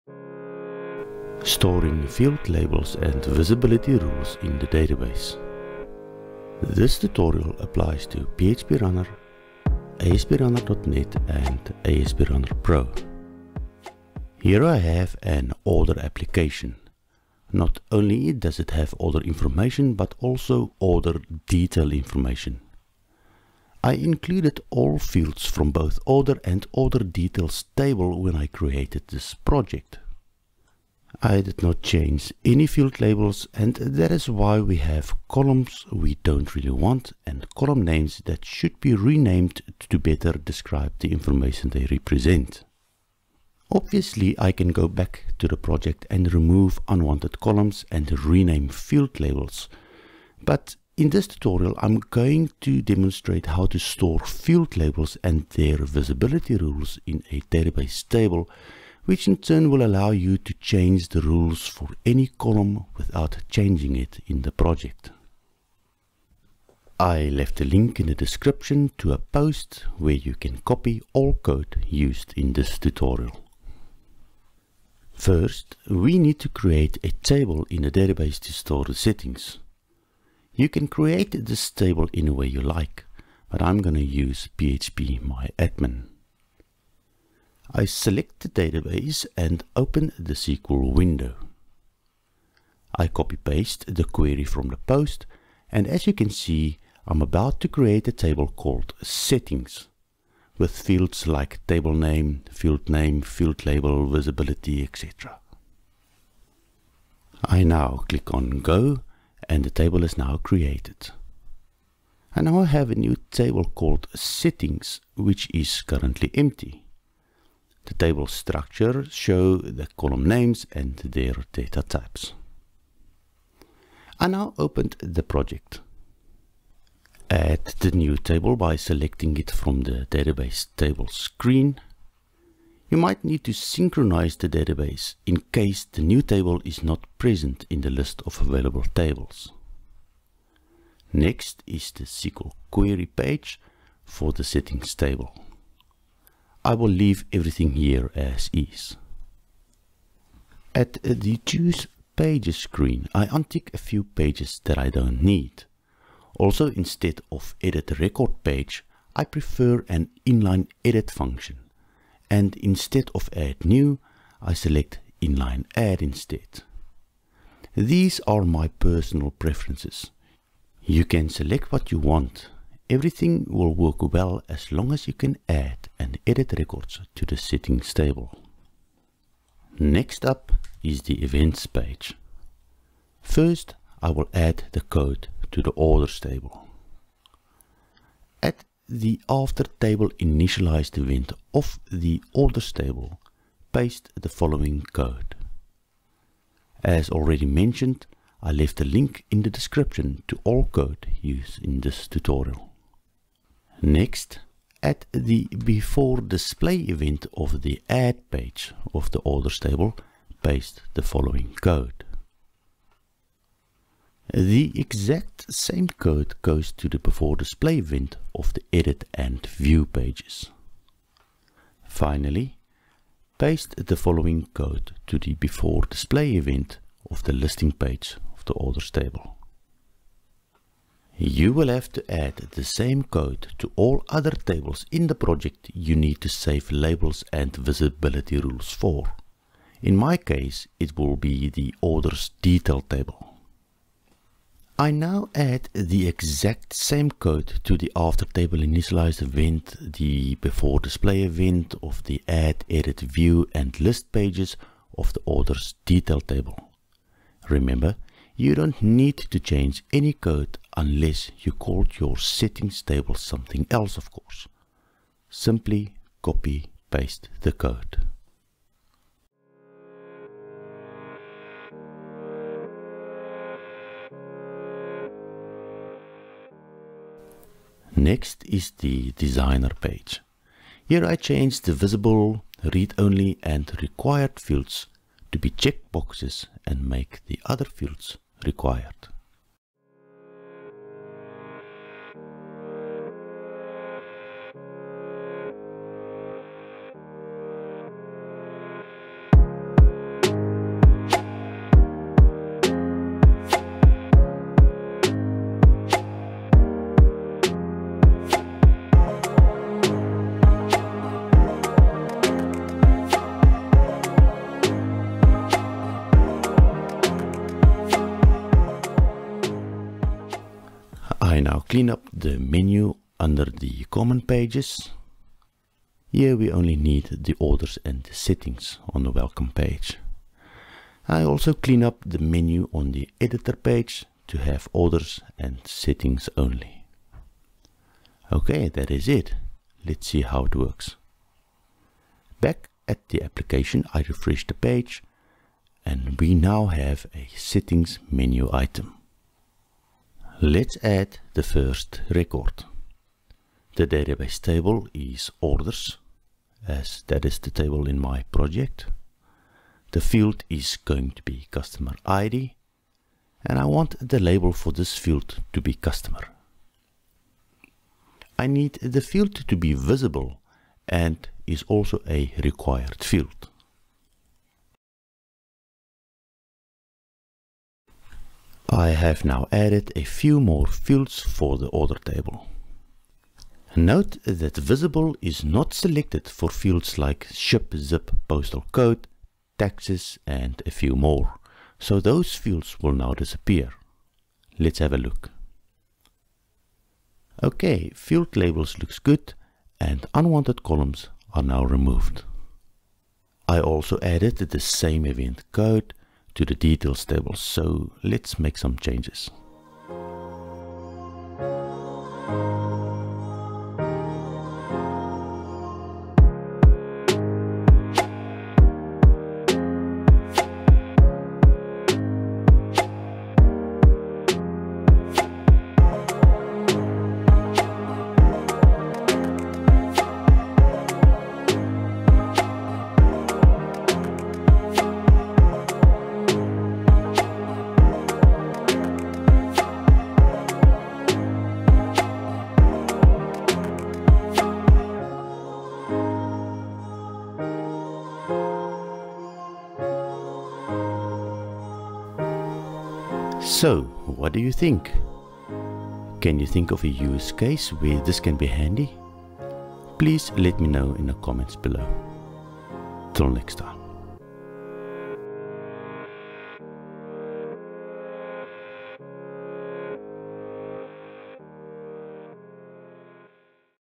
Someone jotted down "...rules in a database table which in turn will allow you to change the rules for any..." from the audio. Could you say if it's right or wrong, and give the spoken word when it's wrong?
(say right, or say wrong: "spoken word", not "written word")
right.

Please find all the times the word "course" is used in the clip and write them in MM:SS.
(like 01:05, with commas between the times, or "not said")
04:24.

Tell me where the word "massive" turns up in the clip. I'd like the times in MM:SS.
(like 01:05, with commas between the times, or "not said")
not said.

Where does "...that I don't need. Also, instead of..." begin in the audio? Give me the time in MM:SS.
02:34.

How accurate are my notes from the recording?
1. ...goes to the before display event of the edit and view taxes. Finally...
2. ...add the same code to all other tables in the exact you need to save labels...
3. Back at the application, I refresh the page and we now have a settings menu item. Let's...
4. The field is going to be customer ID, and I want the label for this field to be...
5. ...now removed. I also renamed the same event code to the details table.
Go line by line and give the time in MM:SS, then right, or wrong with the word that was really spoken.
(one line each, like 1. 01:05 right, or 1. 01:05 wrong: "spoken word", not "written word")
1. 03:36 wrong: "pages", not "taxes"
2. 03:52 wrong: "project", not "exact"
3. 05:42 right
4. 05:59 right
5. 06:41 wrong: "added", not "renamed".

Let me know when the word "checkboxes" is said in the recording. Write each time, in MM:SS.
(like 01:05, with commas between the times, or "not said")
04:45.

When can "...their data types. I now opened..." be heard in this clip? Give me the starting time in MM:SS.
02:00.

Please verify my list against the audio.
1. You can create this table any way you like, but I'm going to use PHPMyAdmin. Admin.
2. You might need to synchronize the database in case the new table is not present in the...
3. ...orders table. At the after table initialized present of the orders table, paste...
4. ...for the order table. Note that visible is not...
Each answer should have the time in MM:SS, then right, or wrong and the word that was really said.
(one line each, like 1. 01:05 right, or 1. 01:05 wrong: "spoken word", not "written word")
1. 01:20 right
2. 02:12 right
3. 03:05 wrong: "event", not "present"
4. 06:21 right.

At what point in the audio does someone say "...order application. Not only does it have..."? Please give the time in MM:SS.
00:15.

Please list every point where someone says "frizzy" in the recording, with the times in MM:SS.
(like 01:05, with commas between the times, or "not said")
not said.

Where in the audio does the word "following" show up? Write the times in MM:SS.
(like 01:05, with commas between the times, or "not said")
03:14, 03:31, 03:43.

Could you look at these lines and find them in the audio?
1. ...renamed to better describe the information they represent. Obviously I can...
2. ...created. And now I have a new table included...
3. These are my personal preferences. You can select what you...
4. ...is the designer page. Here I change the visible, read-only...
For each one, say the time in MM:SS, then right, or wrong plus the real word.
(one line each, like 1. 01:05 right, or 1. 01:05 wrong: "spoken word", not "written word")
1. 00:38 right
2. 01:50 wrong: "called", not "included"
3. 02:47 right
4. 04:38 right.